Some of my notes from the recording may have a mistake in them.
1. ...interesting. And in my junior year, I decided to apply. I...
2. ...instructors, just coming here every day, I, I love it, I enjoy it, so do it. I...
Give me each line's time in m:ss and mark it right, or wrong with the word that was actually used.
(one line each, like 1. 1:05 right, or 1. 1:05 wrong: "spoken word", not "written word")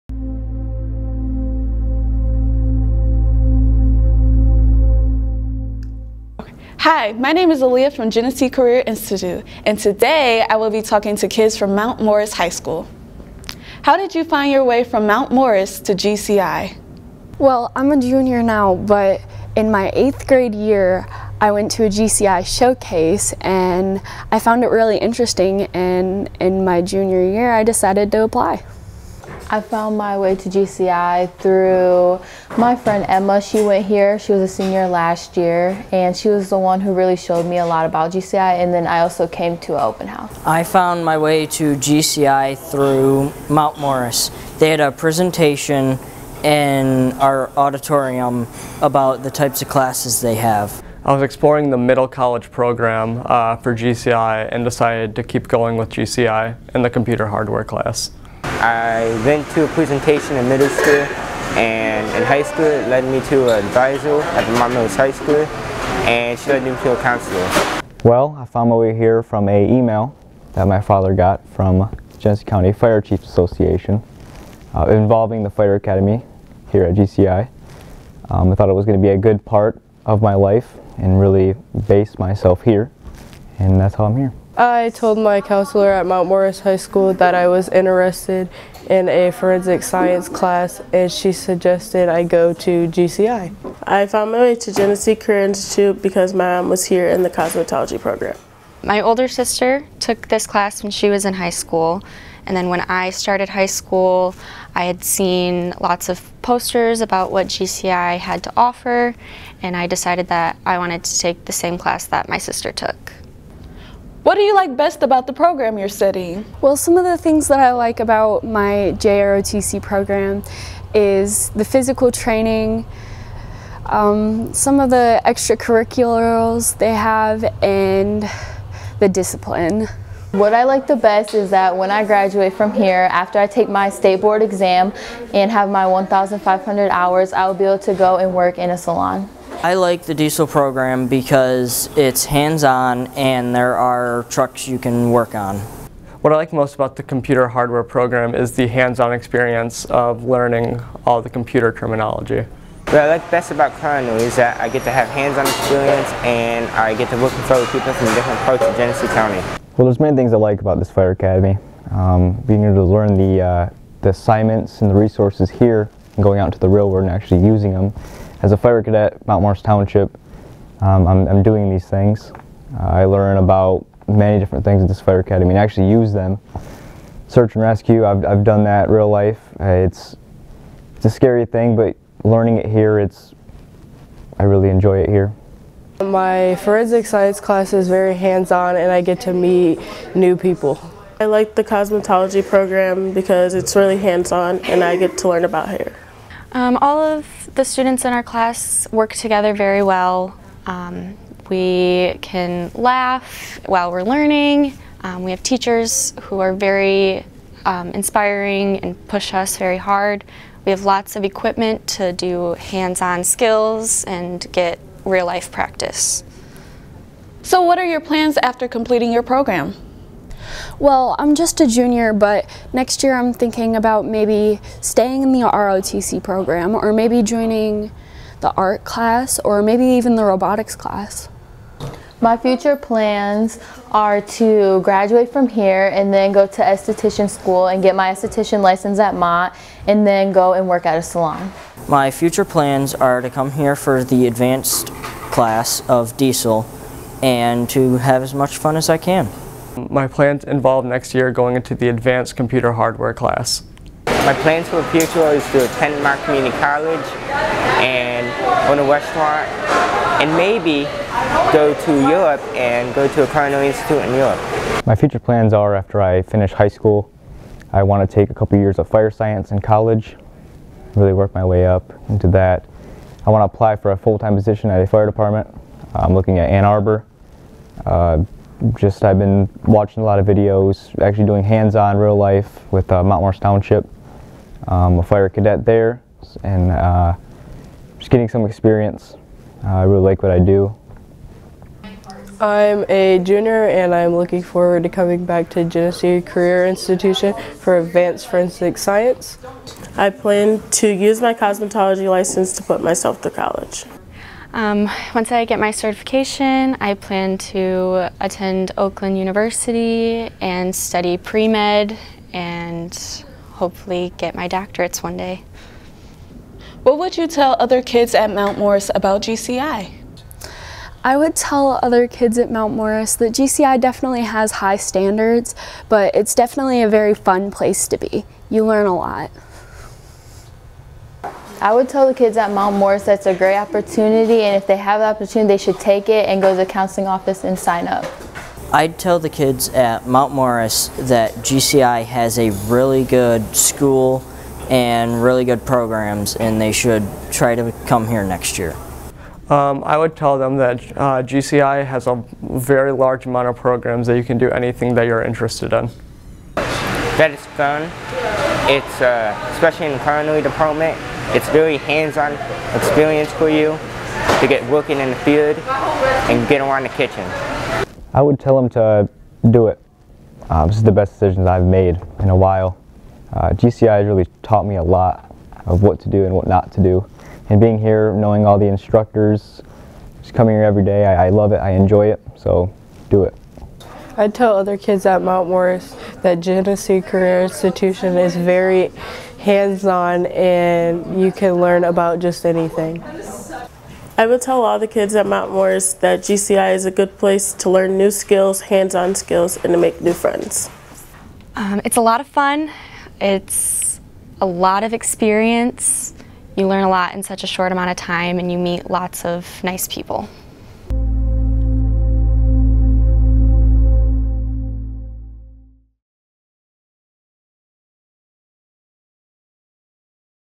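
1. 0:24 right
2. 6:18 right.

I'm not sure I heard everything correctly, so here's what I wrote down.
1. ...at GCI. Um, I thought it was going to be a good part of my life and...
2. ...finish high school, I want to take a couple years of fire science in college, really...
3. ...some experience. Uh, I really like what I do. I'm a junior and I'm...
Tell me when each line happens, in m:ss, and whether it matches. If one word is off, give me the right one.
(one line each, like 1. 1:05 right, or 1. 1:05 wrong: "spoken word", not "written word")
1. 1:16 right
2. 4:26 right
3. 4:48 right.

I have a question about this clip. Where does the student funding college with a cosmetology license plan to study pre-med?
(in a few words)
Oakland University.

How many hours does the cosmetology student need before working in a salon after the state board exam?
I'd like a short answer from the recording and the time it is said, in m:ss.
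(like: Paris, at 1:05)
1,500, at 2:15.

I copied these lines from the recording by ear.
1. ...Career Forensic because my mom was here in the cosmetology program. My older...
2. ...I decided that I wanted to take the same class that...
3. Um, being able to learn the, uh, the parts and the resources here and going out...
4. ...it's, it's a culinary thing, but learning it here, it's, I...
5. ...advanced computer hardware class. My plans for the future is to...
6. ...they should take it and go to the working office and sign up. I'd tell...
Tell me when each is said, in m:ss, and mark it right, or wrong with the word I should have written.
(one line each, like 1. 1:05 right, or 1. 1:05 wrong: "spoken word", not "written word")
1. 1:35 wrong: "Institute", not "Forensic"
2. 1:49 right
3. 2:41 wrong: "assignments", not "parts"
4. 2:59 wrong: "scary", not "culinary"
5. 4:11 right
6. 5:35 wrong: "counseling", not "working".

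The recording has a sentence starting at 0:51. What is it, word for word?
I was exploring the middle college program uh, for GCI and decided to keep going with GCI in the computer hardware class.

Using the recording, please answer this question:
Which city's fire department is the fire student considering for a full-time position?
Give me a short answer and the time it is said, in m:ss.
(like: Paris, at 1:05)
Ann Arbor, at 4:36.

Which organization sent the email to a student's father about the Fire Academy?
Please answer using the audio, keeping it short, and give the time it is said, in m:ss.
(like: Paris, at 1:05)
Genesee County Fire Chiefs Association, at 1:12.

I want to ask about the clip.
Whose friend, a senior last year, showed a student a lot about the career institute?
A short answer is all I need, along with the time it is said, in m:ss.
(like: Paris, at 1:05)
Emma, at 0:33.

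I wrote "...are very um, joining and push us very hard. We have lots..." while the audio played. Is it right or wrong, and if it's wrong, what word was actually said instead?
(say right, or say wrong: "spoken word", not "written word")
wrong: "inspiring", not "joining".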